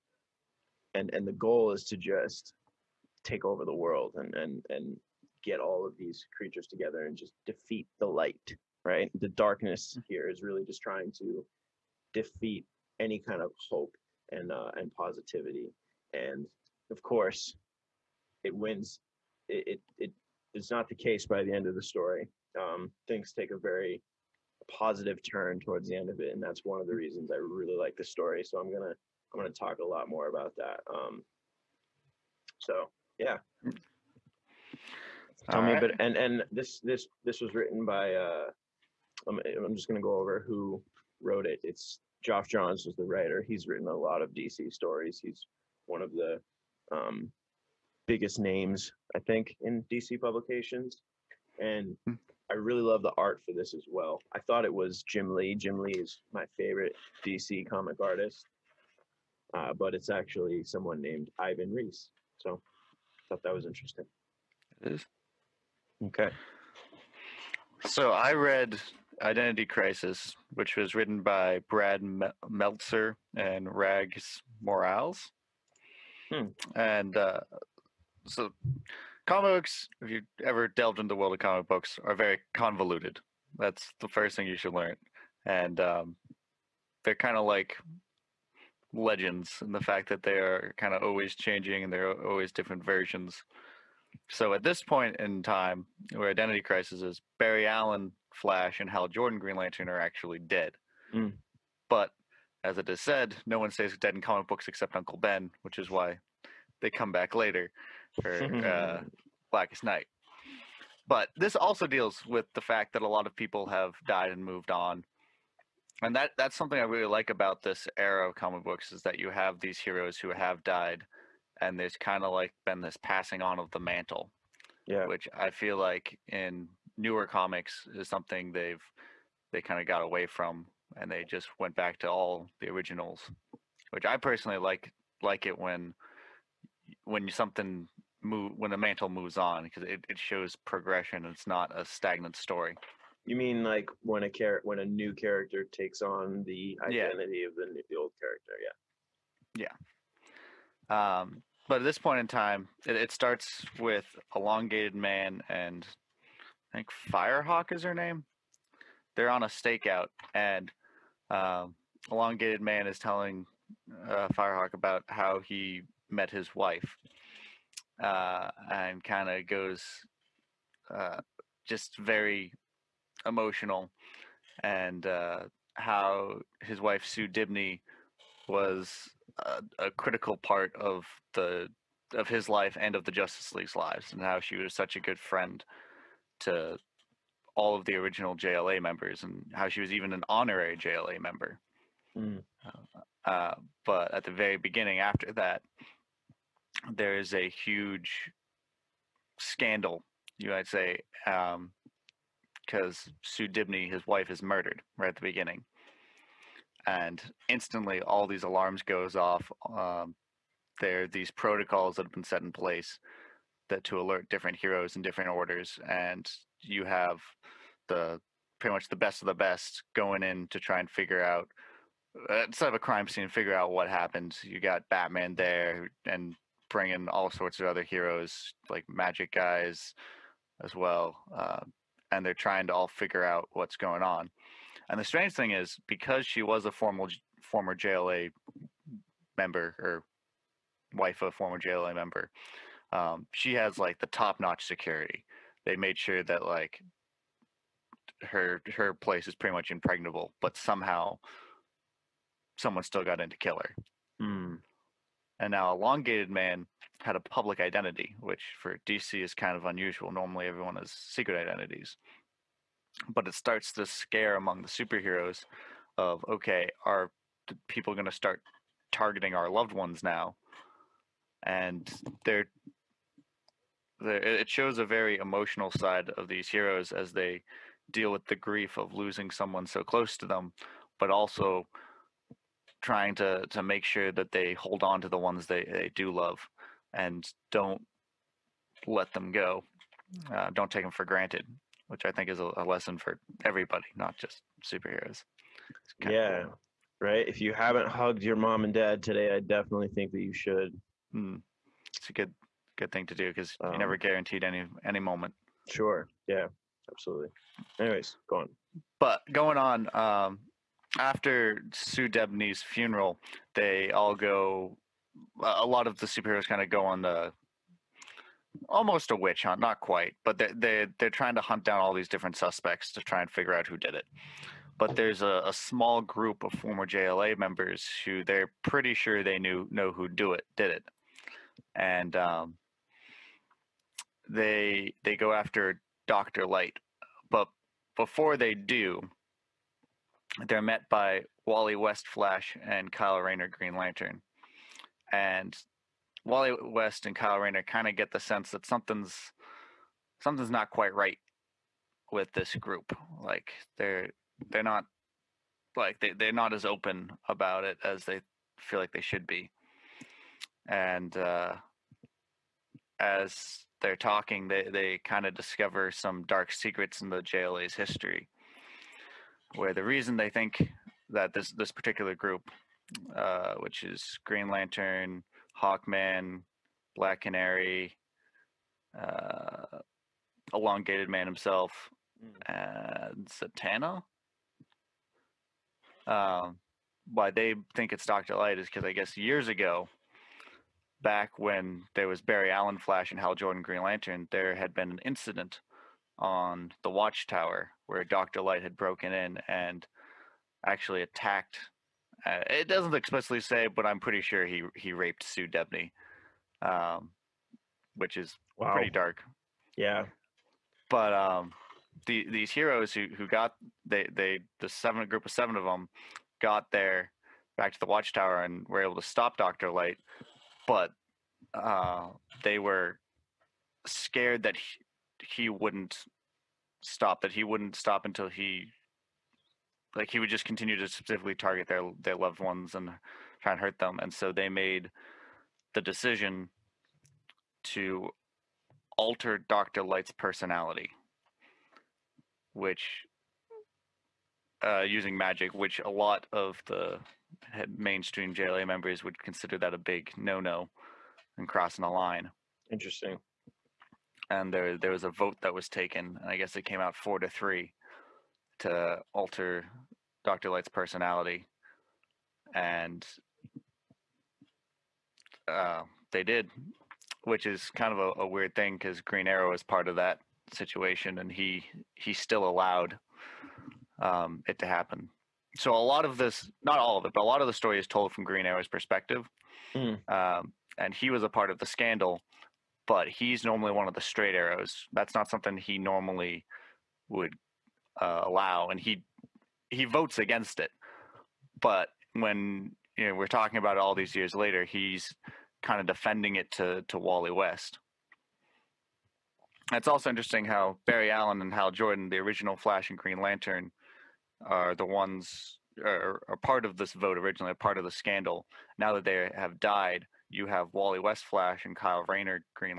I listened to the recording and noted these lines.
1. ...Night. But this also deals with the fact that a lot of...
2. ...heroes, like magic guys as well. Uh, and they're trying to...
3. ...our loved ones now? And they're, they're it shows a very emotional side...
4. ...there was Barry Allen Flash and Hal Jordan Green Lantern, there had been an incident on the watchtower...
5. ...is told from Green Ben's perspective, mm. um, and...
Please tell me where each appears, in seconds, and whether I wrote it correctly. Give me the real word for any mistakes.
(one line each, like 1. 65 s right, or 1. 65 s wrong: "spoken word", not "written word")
1. 109 s right
2. 227 s right
3. 269 s right
4. 391 s right
5. 477 s wrong: "Arrow", not "Ben".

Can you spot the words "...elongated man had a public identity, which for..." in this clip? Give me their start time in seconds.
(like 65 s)
255 s.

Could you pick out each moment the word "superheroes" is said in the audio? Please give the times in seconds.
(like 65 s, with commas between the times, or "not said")
264 s, 294 s, 316 s.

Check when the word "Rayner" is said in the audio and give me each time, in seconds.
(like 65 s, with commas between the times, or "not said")
343 s, 347 s, 512 s.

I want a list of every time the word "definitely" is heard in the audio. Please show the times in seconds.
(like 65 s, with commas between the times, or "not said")
299 s.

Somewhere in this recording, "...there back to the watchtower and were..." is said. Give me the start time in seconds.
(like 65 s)
416 s.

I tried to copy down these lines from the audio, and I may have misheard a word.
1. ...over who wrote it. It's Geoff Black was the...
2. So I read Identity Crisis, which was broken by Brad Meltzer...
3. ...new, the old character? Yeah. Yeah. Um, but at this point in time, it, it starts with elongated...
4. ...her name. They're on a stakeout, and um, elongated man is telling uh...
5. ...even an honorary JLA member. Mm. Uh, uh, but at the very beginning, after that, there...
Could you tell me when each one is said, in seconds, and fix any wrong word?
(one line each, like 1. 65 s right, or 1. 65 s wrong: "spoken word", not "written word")
1. 40 s wrong: "Johns", not "Black"
2. 67 s wrong: "written", not "broken"
3. 147 s right
4. 157 s right
5. 189 s right.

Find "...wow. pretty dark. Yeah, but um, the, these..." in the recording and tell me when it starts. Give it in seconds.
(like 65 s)
408 s.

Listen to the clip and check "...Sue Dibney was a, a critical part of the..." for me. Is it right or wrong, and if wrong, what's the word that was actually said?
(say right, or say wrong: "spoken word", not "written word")
right.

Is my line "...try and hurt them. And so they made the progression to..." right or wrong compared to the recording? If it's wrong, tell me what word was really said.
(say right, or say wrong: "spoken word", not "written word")
wrong: "decision", not "progression".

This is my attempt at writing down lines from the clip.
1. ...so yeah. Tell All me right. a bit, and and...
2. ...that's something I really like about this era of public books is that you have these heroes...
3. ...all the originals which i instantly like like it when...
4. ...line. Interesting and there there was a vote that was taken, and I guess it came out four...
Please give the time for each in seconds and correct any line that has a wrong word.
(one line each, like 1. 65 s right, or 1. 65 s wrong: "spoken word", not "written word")
1. 32 s right
2. 116 s wrong: "comic", not "public"
3. 132 s wrong: "personally", not "instantly"
4. 451 s right.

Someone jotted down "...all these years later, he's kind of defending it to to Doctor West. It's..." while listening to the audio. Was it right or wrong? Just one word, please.
wrong.